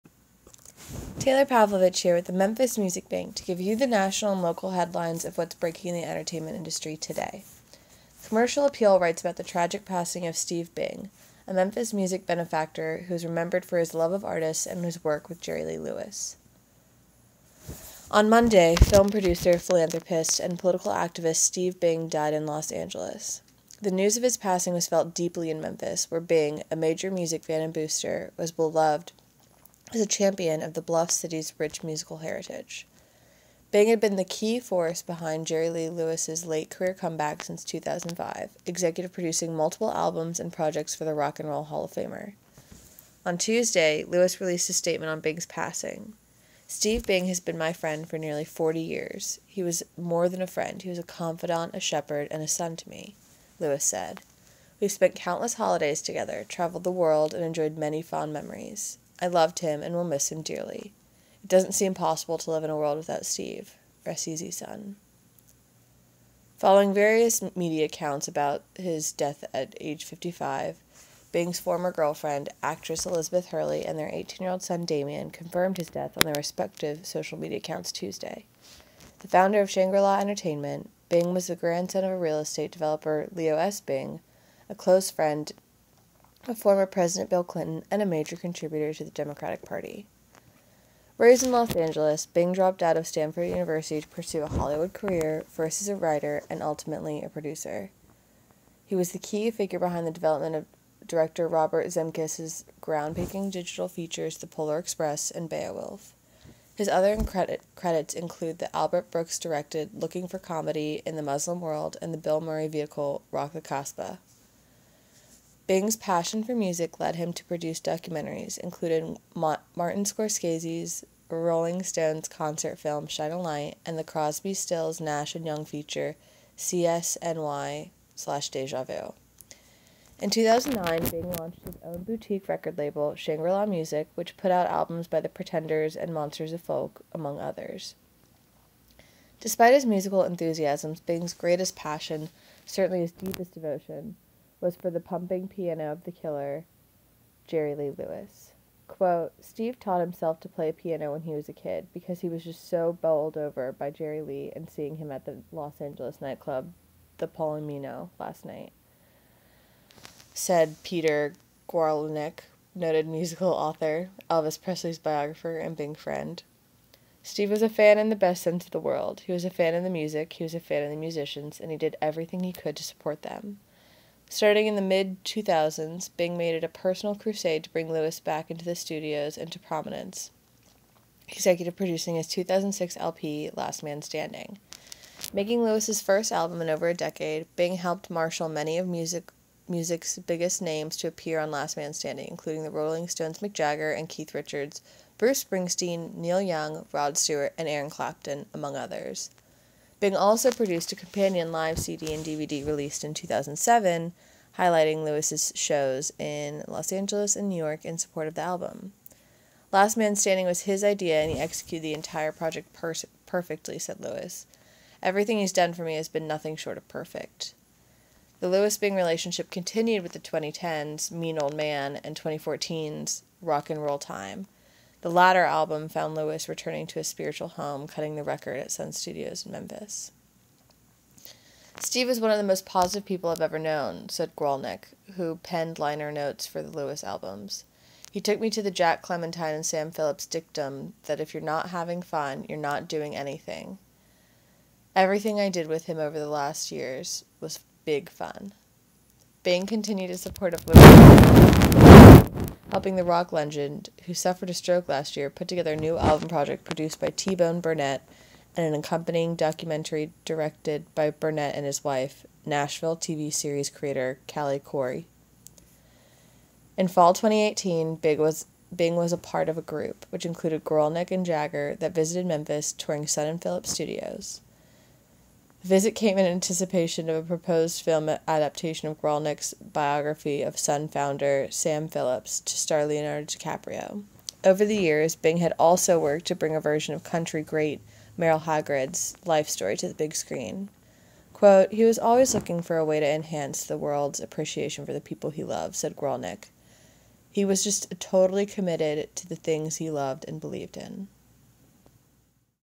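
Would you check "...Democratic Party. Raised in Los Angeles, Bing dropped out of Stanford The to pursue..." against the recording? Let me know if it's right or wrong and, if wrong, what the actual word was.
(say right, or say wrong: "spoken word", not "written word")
wrong: "University", not "The".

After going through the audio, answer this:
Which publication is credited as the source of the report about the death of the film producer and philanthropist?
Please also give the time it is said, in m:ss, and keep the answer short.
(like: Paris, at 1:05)
Commercial Appeal, at 0:08.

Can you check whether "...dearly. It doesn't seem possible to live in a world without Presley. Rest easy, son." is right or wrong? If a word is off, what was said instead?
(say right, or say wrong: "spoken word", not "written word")
wrong: "Steve", not "Presley".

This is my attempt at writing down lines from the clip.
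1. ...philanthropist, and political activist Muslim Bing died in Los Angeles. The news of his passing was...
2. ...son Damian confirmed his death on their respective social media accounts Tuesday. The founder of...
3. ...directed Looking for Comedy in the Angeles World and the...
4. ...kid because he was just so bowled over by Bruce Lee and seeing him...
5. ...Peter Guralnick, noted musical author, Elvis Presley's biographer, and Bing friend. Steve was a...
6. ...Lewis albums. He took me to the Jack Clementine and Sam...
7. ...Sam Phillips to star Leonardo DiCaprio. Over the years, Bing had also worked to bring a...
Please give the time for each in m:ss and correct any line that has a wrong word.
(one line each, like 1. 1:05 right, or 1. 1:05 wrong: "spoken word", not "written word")
1. 0:19 wrong: "Steve", not "Muslim"
2. 1:14 right
3. 1:49 wrong: "Muslim", not "Angeles"
4. 2:31 wrong: "Jerry", not "Bruce"
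5. 2:40 right
6. 3:56 right
7. 4:41 right.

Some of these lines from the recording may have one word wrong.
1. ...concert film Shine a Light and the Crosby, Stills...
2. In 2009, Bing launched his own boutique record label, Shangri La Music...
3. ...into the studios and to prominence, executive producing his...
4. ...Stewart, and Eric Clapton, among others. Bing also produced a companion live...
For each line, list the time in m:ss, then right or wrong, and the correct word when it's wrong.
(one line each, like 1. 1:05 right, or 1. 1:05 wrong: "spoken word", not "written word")
1. 2:02 right
2. 2:10 right
3. 2:58 right
4. 3:17 right.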